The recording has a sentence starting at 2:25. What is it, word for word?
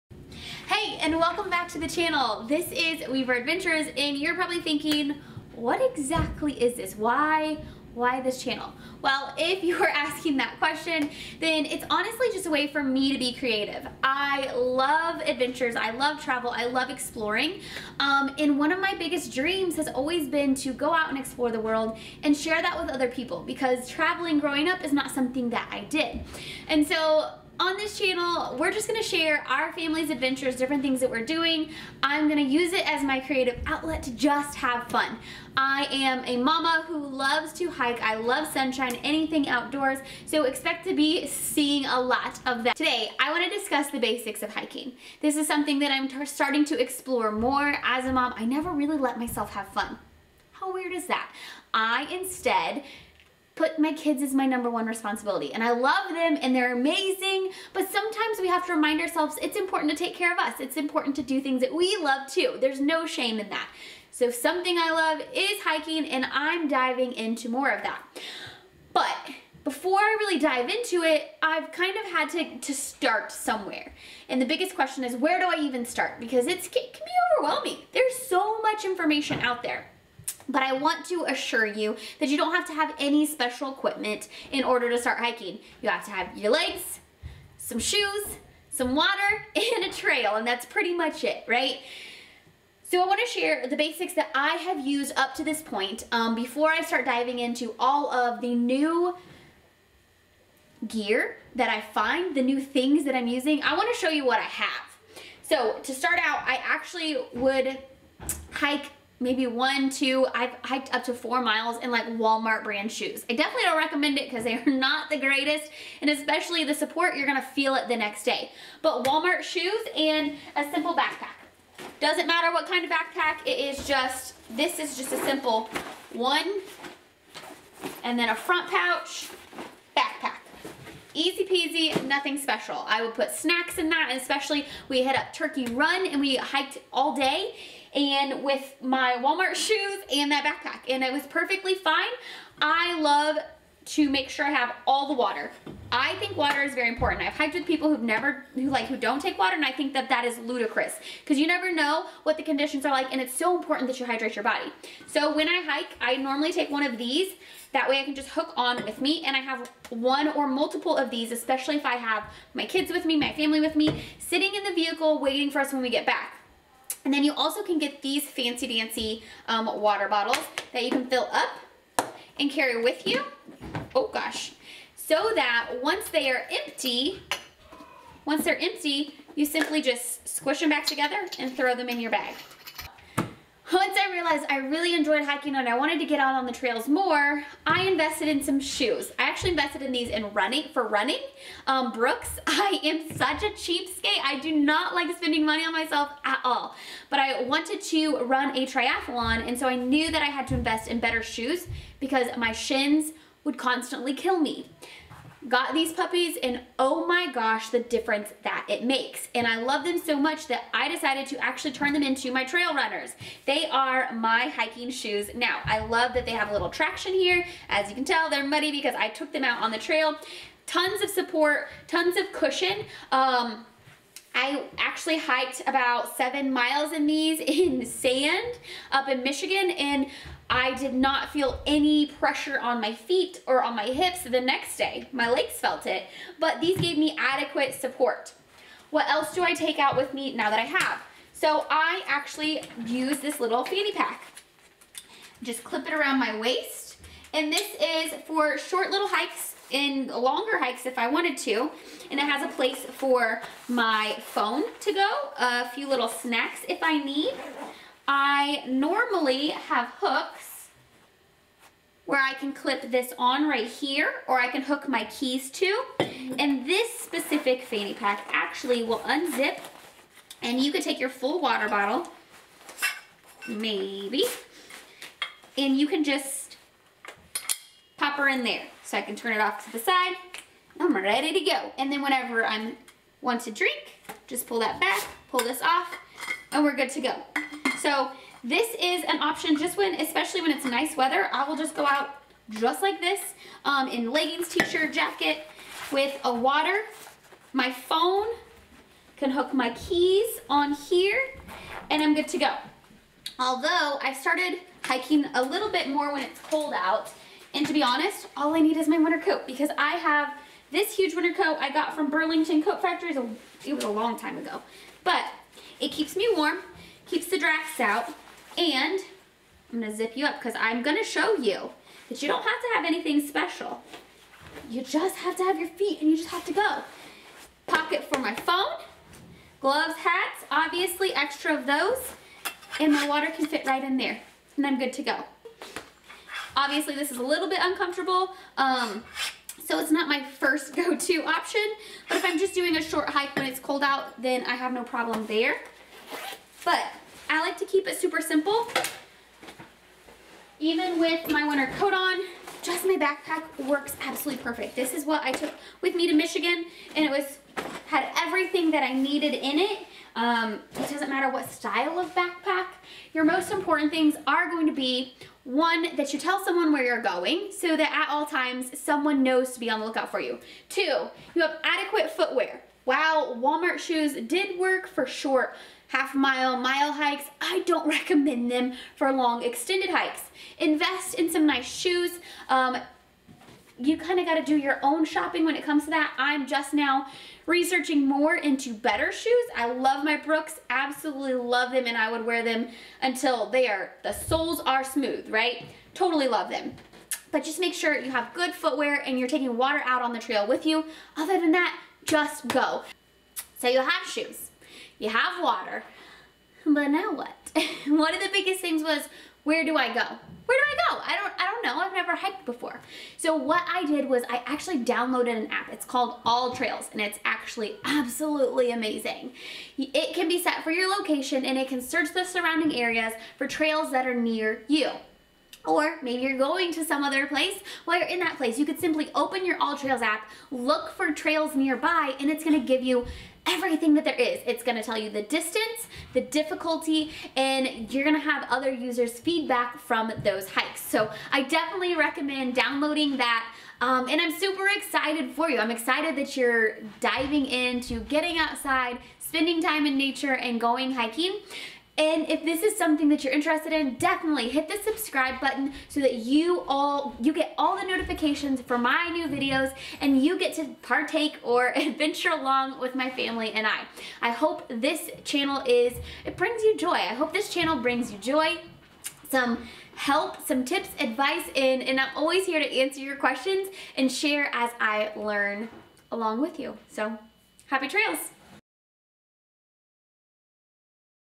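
I think water is very important.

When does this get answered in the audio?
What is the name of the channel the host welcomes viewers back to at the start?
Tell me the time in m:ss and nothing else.
0:03.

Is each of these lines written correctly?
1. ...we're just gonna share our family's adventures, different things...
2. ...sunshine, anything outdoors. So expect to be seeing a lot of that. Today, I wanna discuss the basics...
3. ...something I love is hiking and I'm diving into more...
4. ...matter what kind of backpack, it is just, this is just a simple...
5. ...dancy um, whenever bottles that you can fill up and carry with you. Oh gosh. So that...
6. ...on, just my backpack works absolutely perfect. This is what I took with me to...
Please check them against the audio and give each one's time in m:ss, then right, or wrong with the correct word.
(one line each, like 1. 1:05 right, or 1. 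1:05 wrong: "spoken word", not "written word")
1. 0:28 right
2. 0:38 right
3. 1:04 right
4. 2:02 right
5. 2:48 wrong: "water", not "whenever"
6. 5:51 right.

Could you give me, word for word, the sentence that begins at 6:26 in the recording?
I'm just now researching more into better shoes.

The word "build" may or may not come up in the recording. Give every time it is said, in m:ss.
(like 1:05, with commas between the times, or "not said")
not said.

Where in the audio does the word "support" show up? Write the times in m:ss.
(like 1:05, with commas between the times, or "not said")
1:56, 3:41, 3:57.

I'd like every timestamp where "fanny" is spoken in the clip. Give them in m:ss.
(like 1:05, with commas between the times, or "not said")
4:03, 4:27.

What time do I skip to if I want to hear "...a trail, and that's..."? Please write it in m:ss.
1:29.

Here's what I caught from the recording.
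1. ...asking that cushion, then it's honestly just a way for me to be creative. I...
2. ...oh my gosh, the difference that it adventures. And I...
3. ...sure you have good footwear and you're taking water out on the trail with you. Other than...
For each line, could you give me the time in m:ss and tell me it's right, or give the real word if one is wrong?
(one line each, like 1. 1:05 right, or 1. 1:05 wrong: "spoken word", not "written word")
1. 0:09 wrong: "question", not "cushion"
2. 3:26 wrong: "makes", not "adventures"
3. 6:37 right.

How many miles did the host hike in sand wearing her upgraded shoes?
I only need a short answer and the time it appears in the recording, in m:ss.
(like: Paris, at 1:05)
7 miles, at 3:46.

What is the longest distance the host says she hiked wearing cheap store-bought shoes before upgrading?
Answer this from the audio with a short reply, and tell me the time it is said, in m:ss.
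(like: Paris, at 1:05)
4 miles, at 1:51.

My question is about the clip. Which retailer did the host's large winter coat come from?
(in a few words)
Burlington Coat Factory.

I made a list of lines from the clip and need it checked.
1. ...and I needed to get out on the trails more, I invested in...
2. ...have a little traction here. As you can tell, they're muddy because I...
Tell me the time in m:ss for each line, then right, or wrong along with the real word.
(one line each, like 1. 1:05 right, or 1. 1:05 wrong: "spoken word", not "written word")
1. 3:05 wrong: "wanted", not "needed"
2. 3:36 right.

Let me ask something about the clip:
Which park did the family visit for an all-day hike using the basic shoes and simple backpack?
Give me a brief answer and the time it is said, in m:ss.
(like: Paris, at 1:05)
Turkey Run, at 2:15.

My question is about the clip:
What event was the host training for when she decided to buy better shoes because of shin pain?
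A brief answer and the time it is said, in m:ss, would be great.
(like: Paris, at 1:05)
A triathlon, at 3:18.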